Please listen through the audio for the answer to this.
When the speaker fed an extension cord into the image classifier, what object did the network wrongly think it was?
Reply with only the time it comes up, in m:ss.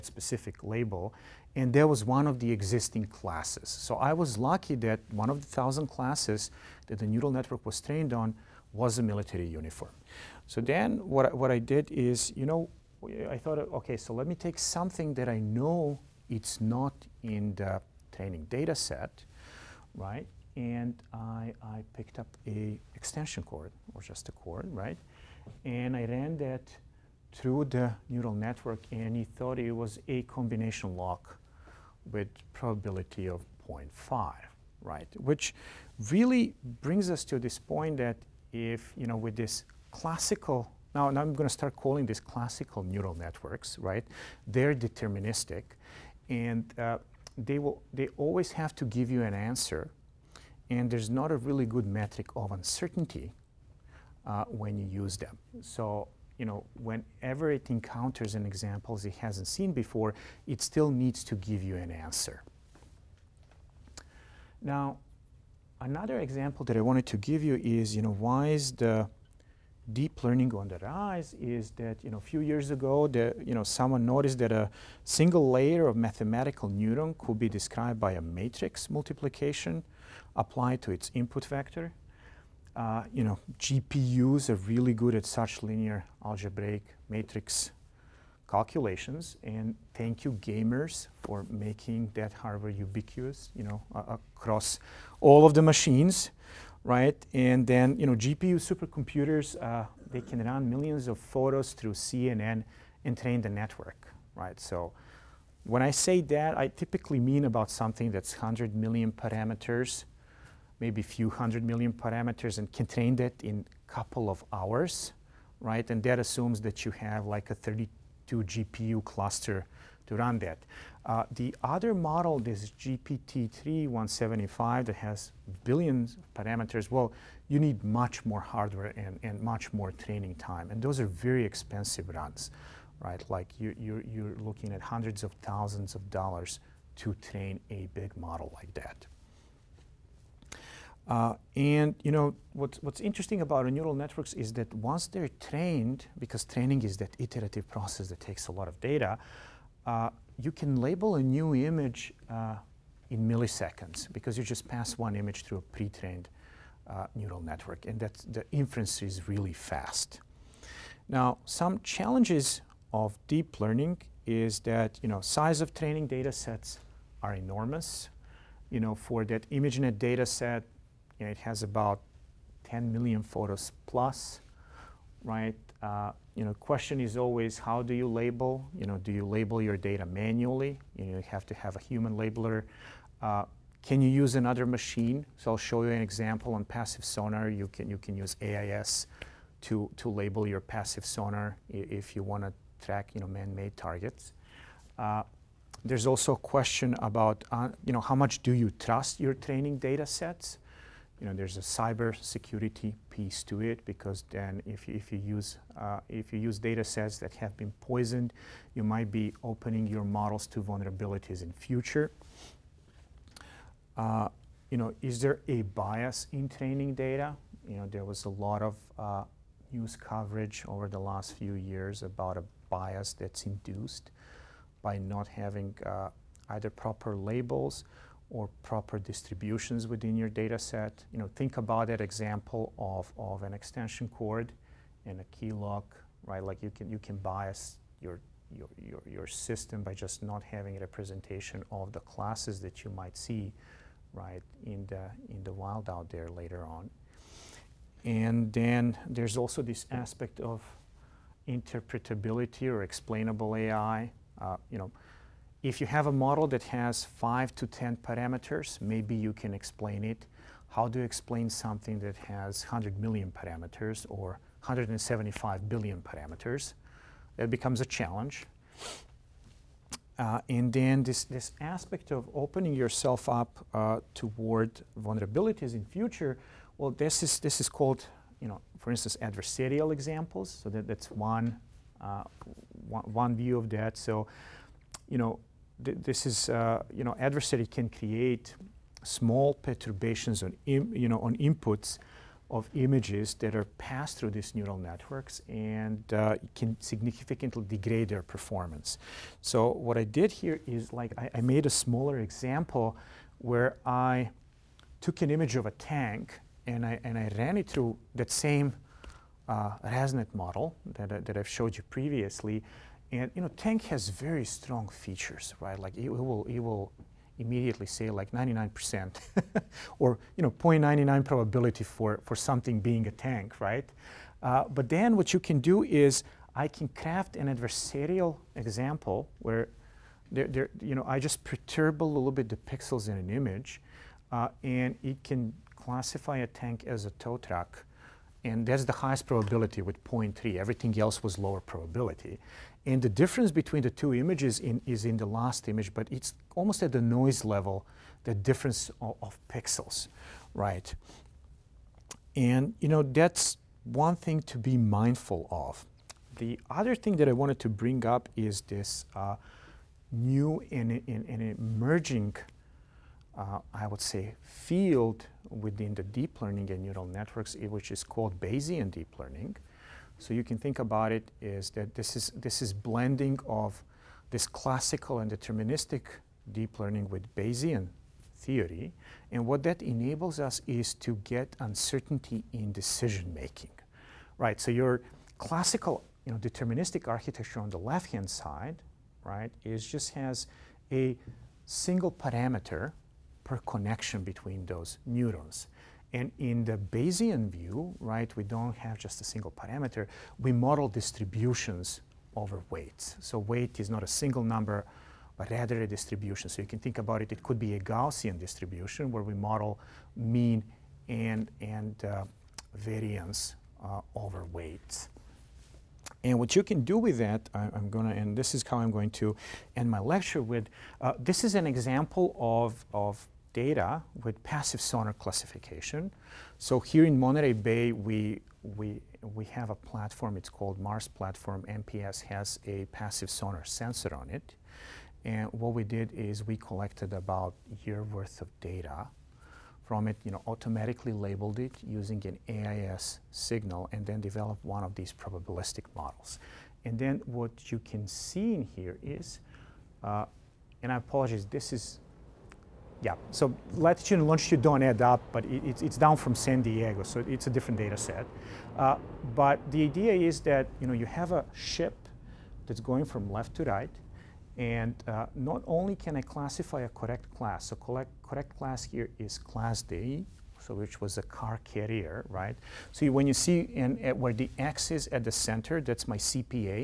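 0:30.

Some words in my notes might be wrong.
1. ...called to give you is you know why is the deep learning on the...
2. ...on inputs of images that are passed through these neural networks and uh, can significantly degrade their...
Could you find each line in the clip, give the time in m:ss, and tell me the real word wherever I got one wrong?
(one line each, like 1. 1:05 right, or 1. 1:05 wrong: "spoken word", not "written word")
1. 1:06 wrong: "wanted", not "called"
2. 4:51 right.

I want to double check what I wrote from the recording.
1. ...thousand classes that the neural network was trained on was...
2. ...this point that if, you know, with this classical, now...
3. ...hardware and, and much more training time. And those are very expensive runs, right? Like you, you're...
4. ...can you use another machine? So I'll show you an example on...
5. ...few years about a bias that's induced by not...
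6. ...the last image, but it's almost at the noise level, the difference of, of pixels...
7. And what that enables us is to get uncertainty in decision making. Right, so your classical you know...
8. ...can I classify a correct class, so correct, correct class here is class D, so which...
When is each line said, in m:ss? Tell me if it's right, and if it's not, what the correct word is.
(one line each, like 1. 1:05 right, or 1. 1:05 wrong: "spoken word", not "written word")
1. 0:05 right
2. 0:37 right
3. 2:08 right
4. 3:03 right
5. 3:41 right
6. 5:45 right
7. 6:19 right
8. 7:45 right.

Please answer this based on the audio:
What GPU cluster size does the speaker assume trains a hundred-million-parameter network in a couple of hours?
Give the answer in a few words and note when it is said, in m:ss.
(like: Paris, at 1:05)
32 GPU, at 1:57.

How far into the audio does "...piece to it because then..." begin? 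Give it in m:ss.
3:23.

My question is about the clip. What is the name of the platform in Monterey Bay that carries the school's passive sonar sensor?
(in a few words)
Mars Platform.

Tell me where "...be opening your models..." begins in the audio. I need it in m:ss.
3:29.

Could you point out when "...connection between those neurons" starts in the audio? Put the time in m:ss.
6:33.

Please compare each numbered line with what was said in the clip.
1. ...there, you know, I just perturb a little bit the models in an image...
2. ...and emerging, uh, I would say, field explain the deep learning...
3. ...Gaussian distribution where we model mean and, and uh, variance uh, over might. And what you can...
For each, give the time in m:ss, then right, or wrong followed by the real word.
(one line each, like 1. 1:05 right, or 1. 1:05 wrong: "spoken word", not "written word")
1. 5:30 wrong: "pixels", not "models"
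2. 6:01 wrong: "within", not "explain"
3. 6:47 wrong: "weight", not "might".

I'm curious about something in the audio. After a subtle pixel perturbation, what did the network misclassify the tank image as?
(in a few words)
tow truck.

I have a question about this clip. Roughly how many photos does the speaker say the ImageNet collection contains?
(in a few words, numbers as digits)
10 million.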